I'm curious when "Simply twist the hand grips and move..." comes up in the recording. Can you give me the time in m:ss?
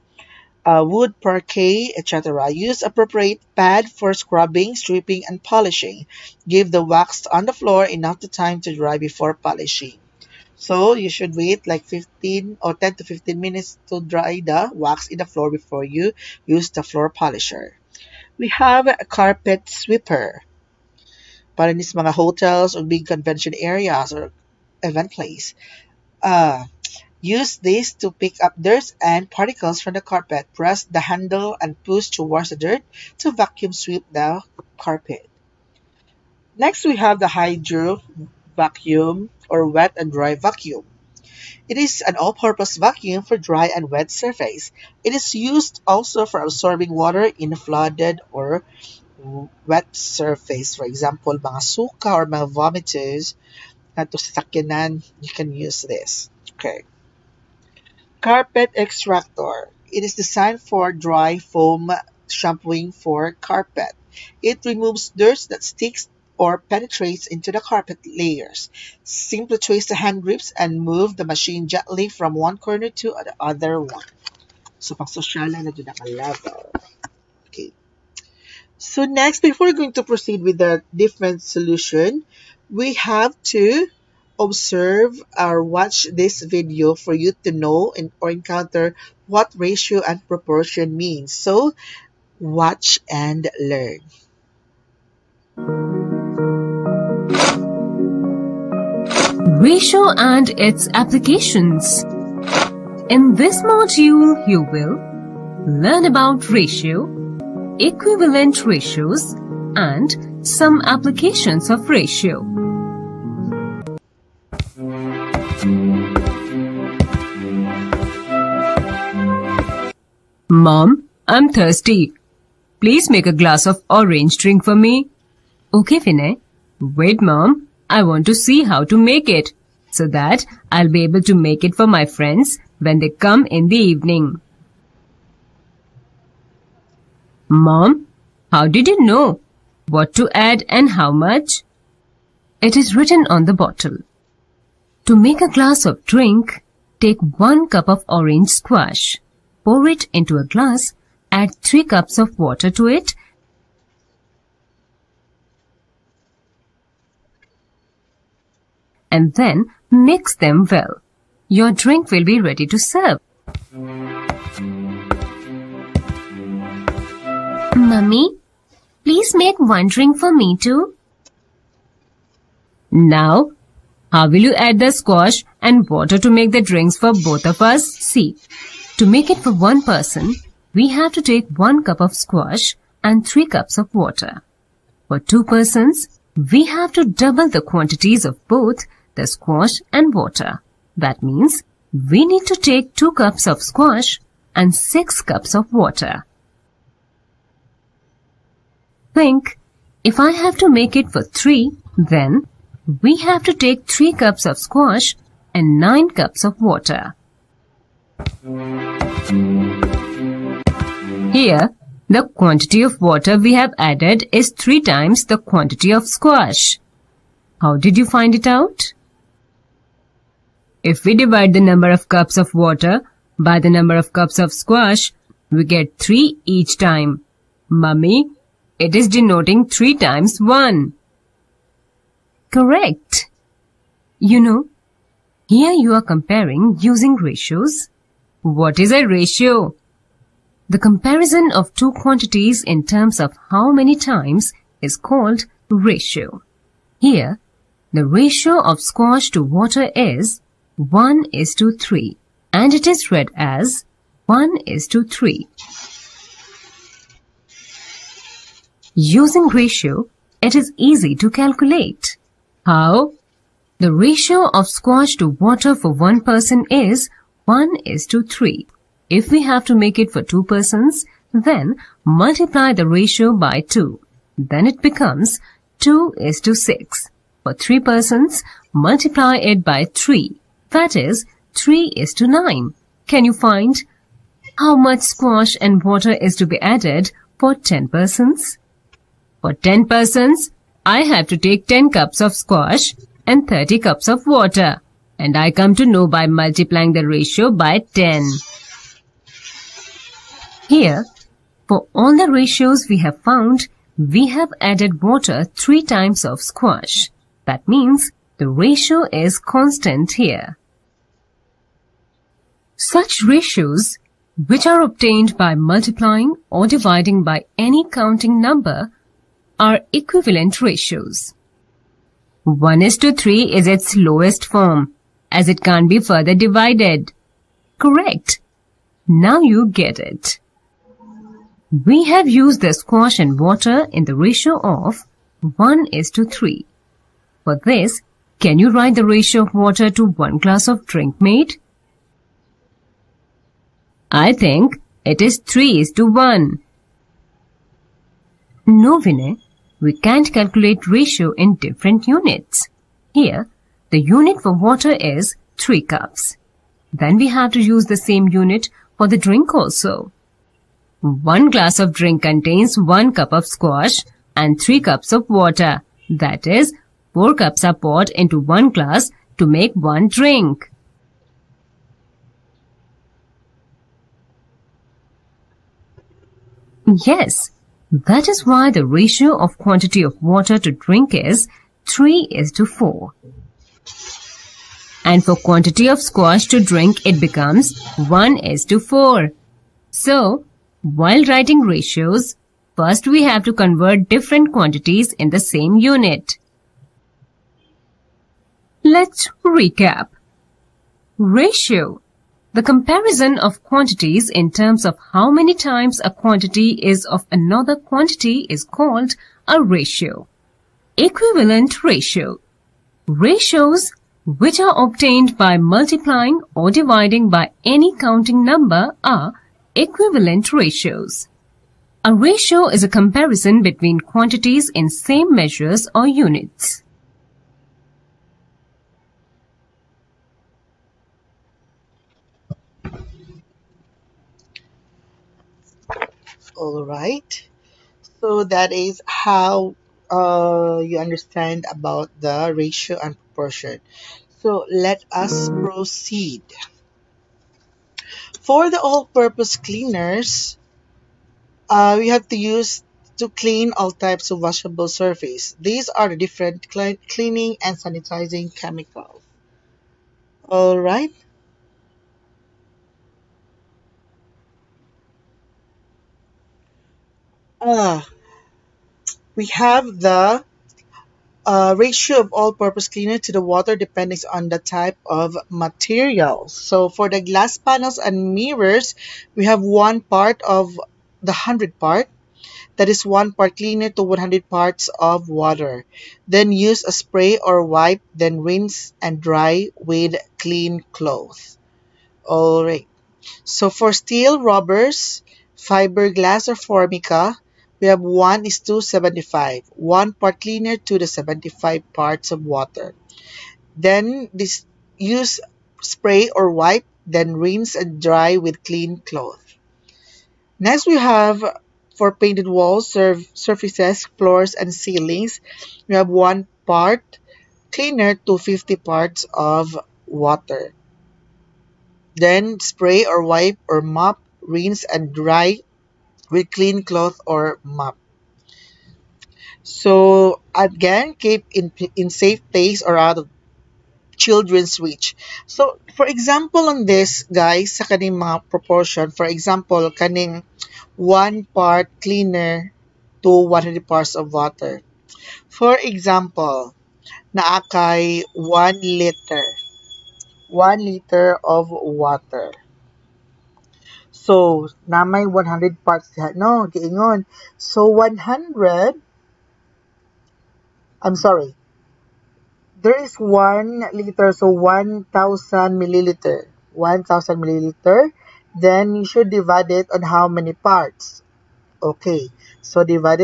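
1:09.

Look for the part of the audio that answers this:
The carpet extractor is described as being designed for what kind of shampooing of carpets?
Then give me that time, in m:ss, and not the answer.
1:00.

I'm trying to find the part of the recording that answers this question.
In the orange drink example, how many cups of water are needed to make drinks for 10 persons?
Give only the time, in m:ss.
4:53.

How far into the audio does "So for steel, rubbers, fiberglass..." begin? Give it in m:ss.
8:13.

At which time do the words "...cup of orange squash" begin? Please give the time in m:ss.
2:27.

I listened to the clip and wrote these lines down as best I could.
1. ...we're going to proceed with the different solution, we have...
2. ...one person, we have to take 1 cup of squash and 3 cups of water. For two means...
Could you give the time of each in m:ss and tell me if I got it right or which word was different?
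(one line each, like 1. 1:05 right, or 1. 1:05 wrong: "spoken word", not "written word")
1. 1:19 right
2. 2:59 wrong: "persons", not "means".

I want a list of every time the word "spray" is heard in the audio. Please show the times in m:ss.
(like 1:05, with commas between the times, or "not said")
8:06, 8:25, 8:42.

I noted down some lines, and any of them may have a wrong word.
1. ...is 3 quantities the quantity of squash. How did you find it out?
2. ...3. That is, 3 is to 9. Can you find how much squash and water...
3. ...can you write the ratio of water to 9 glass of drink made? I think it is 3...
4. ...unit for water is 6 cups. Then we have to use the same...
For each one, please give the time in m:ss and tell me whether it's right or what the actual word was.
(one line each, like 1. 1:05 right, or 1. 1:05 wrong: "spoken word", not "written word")
1. 3:34 wrong: "times", not "quantities"
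2. 4:39 right
3. 5:38 wrong: "1", not "9"
4. 5:54 wrong: "3", not "6".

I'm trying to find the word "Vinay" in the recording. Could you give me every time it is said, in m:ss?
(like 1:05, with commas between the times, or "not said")
2:06, 5:48.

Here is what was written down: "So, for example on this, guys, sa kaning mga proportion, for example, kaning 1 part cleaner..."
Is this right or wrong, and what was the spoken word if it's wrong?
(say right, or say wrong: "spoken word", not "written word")
right.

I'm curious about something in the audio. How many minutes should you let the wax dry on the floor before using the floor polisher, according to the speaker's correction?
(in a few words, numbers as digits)
10 to 15 minutes.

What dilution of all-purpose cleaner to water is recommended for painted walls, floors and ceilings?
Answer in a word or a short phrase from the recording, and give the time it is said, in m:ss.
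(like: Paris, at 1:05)
1 part to 50 parts, at 8:36.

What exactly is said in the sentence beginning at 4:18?
Using ratio, it is easy to calculate.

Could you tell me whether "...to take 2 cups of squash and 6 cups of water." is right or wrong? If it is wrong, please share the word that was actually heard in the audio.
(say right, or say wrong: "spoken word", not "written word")
right.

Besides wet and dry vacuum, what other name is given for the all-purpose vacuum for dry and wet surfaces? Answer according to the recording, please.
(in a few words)
hydro vacuum.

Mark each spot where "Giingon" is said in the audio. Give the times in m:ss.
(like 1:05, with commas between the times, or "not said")
9:16.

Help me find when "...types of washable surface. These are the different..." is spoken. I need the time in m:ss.
7:33.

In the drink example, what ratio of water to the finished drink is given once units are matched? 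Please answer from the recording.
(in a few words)
3 is to 4.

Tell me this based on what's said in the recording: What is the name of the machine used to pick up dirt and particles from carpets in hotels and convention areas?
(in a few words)
carpet sweeper.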